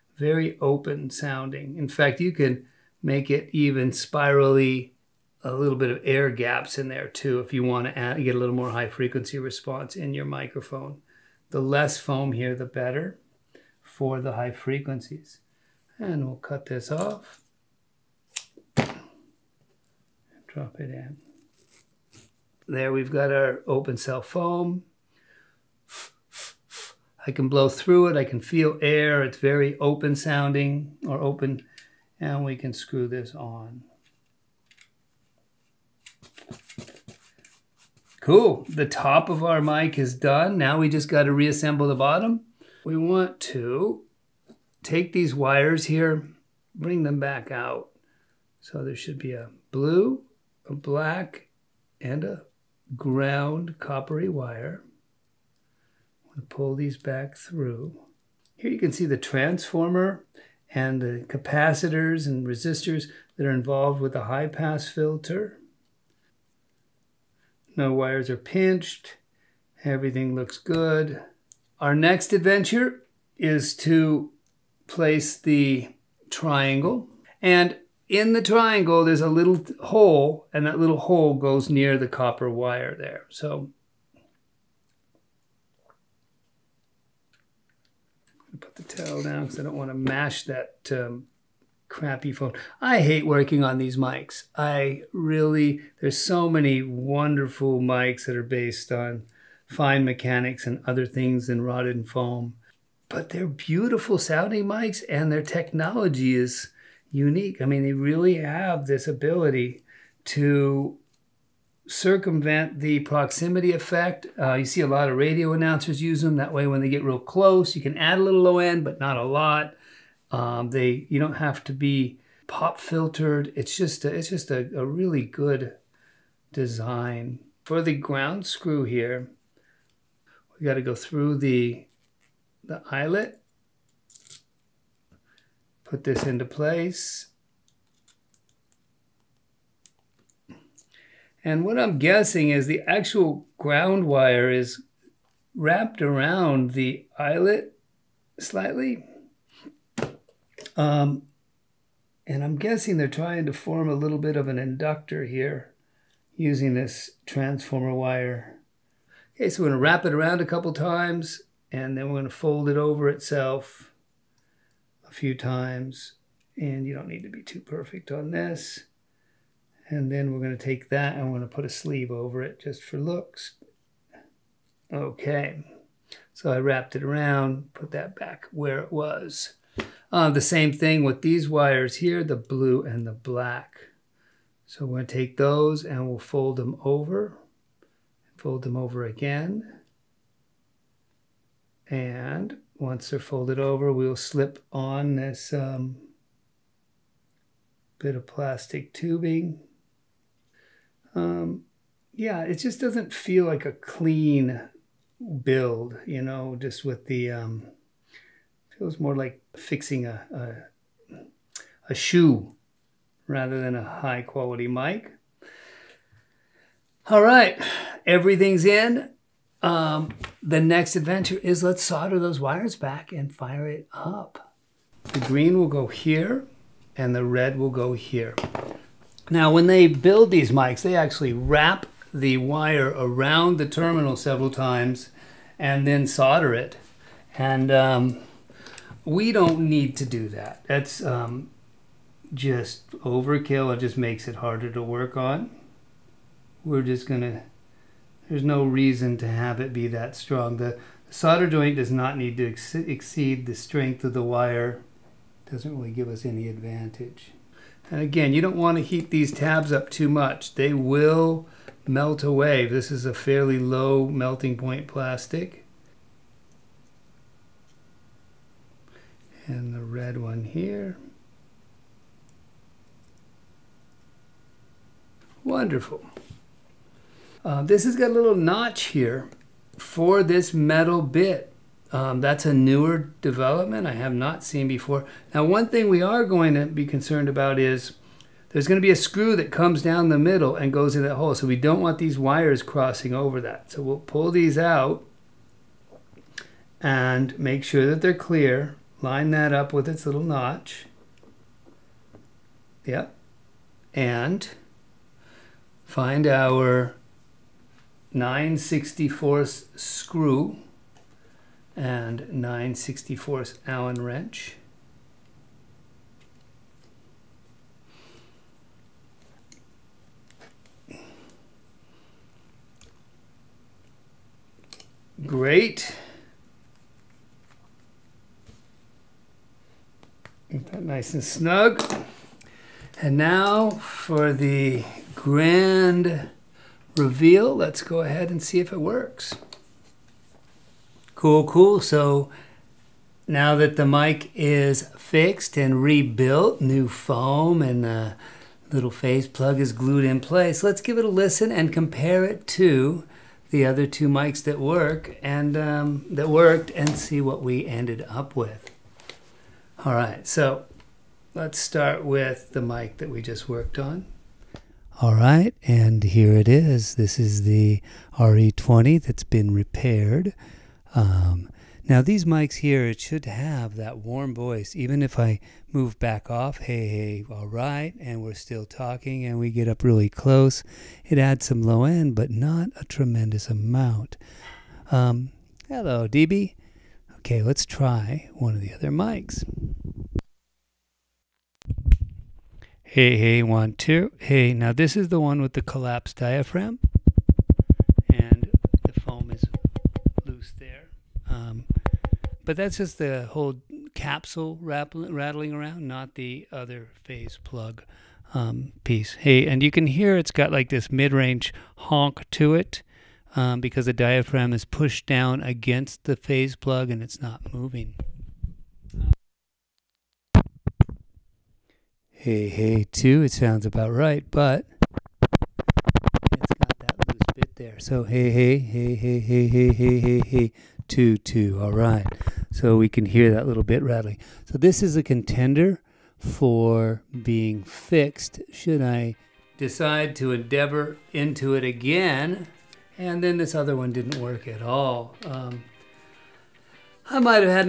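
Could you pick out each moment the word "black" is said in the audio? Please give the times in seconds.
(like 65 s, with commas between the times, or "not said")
50 s, 183 s.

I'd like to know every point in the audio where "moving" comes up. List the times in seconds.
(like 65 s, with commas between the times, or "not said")
417 s.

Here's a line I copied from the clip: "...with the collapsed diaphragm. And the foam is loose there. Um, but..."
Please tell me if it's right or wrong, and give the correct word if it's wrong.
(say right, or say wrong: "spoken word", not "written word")
right.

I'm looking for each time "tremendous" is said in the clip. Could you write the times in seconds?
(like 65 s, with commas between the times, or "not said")
382 s.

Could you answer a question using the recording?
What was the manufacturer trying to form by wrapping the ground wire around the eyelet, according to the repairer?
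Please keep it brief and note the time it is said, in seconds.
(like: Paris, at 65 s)
An inductor, at 154 s.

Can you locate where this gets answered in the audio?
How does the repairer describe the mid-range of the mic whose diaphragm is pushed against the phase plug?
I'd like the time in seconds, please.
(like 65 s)
410 s.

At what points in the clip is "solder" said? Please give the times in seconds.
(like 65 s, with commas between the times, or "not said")
221 s, 236 s, 251 s.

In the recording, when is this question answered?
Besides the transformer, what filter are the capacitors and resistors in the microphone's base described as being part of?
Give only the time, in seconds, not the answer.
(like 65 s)
64 s.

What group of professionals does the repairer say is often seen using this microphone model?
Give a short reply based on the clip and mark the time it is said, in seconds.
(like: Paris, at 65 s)
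Radio announcers, at 115 s.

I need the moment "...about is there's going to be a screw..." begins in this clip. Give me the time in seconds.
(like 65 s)
287 s.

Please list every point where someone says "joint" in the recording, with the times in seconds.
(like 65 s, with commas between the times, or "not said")
251 s.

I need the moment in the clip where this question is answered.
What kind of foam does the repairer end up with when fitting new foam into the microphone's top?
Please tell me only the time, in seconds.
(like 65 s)
23 s.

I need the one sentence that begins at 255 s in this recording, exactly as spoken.
Doesn't really give us any advantage.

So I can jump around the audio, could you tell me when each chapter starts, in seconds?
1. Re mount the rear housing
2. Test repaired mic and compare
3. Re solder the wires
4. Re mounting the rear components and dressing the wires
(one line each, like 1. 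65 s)
1. 285 s
2. 338 s
3. 221 s
4. 41 s.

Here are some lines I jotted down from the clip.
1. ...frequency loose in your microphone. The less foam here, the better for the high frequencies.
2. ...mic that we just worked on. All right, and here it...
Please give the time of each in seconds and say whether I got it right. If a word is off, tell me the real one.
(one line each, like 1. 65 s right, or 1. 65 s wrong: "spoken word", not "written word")
1. 8 s wrong: "response", not "loose"
2. 362 s right.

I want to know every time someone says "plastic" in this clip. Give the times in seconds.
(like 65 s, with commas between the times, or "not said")
198 s, 264 s.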